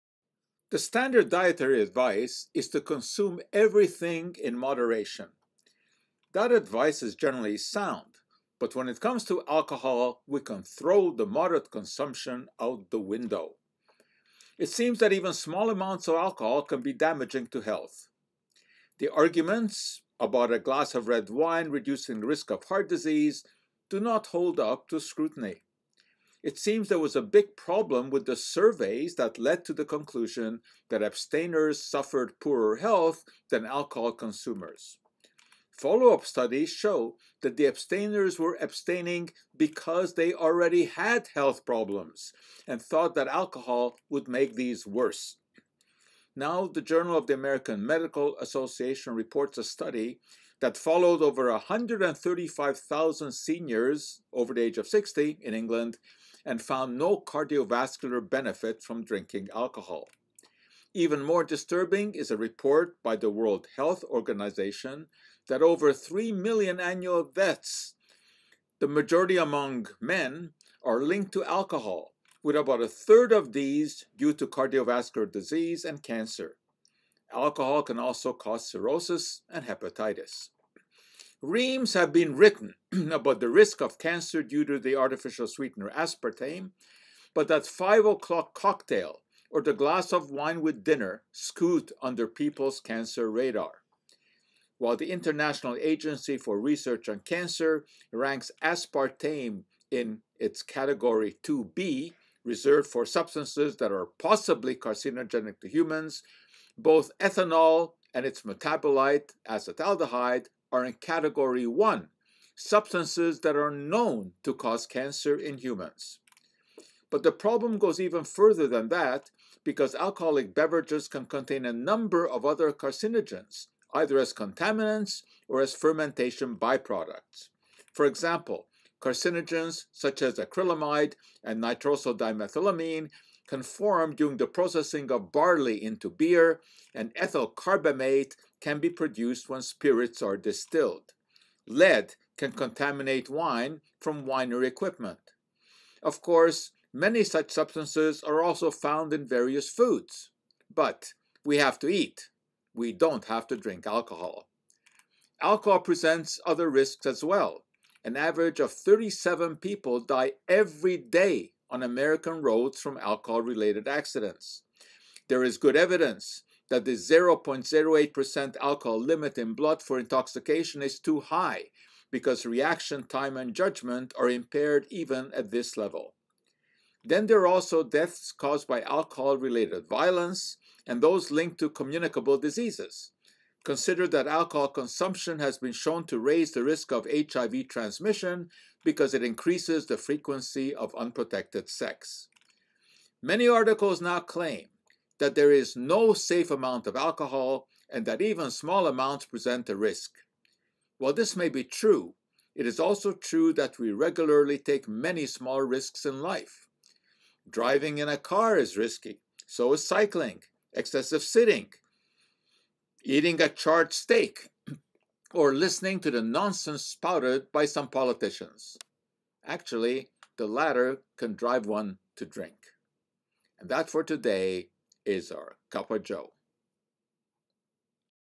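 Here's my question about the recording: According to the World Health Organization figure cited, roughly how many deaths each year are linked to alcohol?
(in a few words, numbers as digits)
over 3 million.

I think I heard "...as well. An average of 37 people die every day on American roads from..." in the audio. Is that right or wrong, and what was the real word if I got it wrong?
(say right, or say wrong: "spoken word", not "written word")
right.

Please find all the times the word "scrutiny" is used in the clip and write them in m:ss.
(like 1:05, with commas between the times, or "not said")
0:25.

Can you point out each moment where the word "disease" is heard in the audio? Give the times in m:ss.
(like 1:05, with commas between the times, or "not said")
0:22, 1:15, 3:02.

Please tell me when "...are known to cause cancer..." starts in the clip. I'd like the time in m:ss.
1:53.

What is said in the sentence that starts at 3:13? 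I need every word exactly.
Many articles now claim that there is no safe amount of alcohol and that even small amounts present a risk.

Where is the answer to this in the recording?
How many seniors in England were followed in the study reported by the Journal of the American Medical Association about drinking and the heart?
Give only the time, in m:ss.
0:51.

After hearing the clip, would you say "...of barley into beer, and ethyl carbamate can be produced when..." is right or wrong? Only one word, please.
right.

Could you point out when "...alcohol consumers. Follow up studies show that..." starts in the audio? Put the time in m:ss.
0:33.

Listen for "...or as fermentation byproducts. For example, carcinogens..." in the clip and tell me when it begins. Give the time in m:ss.
2:05.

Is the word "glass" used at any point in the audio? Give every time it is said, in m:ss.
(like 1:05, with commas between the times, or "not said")
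0:20, 1:29.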